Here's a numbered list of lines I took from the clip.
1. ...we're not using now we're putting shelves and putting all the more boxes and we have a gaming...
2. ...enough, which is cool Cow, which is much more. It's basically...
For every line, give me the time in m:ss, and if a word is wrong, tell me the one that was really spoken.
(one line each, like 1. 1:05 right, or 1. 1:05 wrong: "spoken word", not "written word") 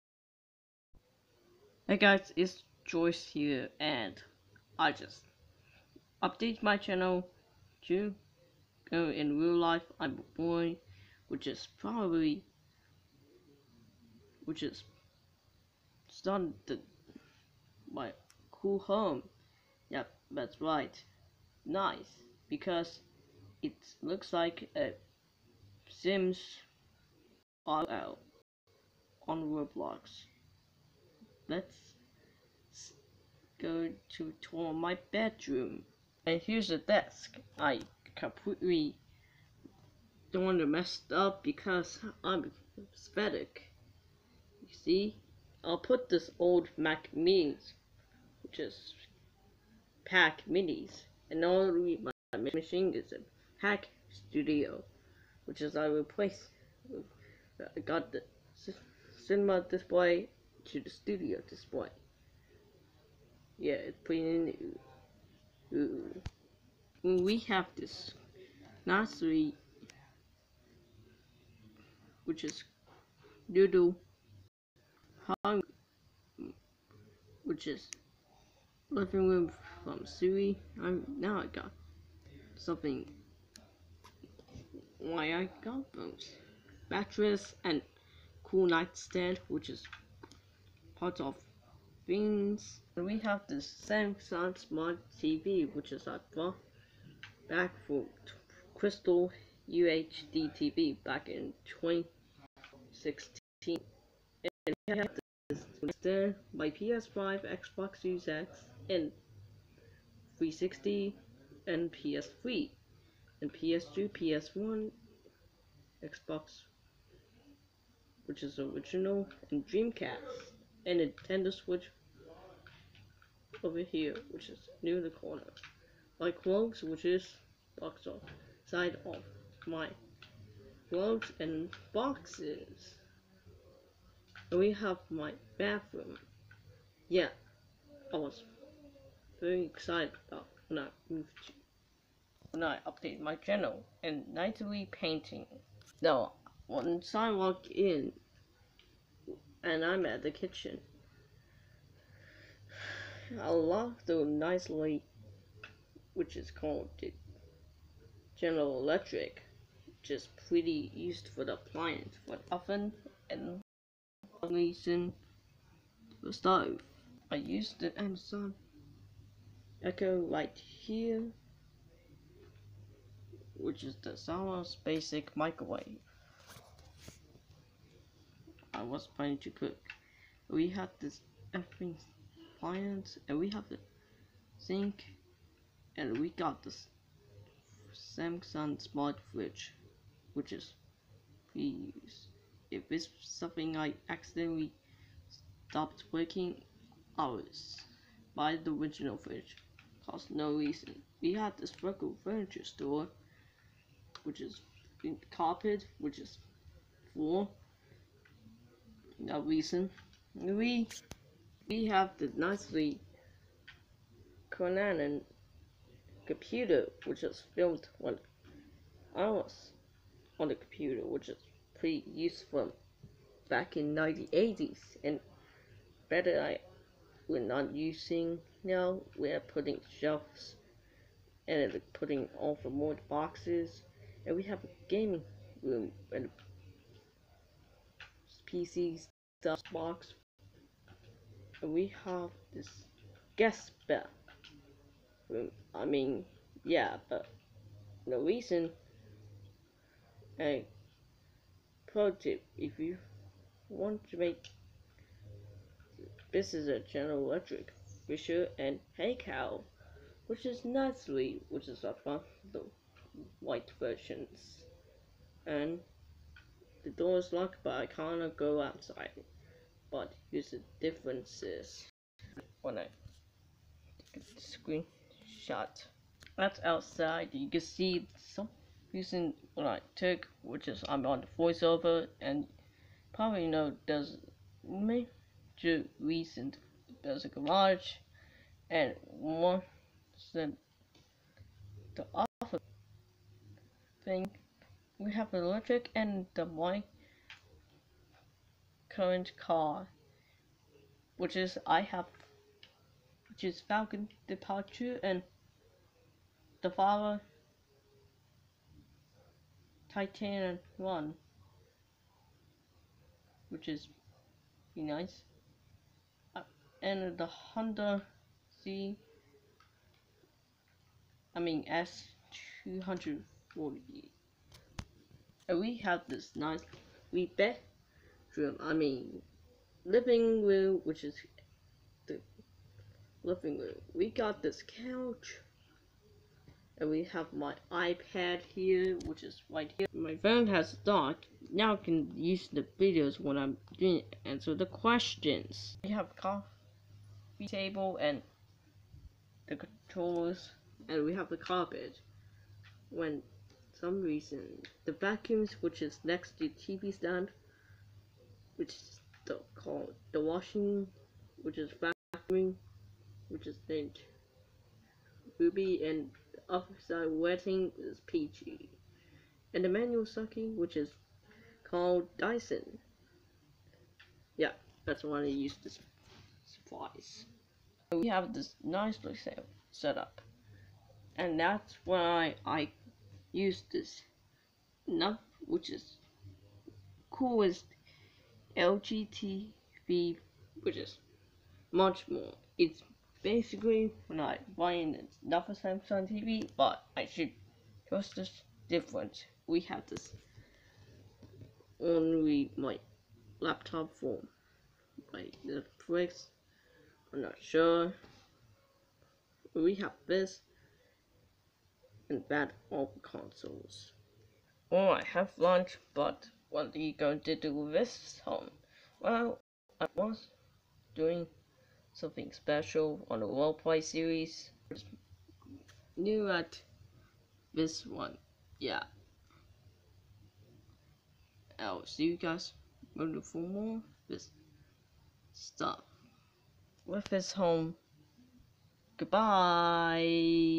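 1. 3:47 right
2. 6:24 wrong: "LGTV", not "Cow".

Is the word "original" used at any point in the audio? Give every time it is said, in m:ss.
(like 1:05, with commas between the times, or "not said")
1:58, 3:18.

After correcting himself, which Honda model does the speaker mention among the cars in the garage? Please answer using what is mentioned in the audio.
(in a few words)
S240.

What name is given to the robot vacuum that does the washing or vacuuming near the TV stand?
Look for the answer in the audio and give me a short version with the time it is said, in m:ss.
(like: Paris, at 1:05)
Ruby, at 6:05.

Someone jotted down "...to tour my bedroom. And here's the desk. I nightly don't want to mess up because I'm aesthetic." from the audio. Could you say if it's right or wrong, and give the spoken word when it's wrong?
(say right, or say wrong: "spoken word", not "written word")
wrong: "completely", not "nightly".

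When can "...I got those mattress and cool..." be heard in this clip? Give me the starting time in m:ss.
1:25.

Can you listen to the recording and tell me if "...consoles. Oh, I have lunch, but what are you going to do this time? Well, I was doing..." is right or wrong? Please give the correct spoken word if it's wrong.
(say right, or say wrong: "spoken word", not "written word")
right.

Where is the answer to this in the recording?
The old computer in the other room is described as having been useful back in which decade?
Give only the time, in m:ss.
3:43.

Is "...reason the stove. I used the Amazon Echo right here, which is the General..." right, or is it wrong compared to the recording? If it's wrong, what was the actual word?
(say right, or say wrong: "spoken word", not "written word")
wrong: "Sonos", not "General".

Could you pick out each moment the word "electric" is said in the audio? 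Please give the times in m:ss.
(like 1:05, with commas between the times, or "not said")
2:38, 4:17, 4:55.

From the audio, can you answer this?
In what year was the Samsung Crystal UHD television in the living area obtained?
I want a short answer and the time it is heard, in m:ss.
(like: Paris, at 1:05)
2016, at 1:41.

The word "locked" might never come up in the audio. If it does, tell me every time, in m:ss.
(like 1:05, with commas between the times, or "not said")
2:33, 4:27.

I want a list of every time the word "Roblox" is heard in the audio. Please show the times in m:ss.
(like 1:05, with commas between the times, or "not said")
0:29.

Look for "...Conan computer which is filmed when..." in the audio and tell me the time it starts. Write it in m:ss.
3:34.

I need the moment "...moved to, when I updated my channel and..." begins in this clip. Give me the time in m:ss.
2:21.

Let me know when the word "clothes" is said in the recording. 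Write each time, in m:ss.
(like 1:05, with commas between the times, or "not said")
2:06, 2:10.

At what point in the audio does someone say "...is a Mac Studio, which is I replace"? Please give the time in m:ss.
0:52.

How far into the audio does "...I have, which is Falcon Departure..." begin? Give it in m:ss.
5:01.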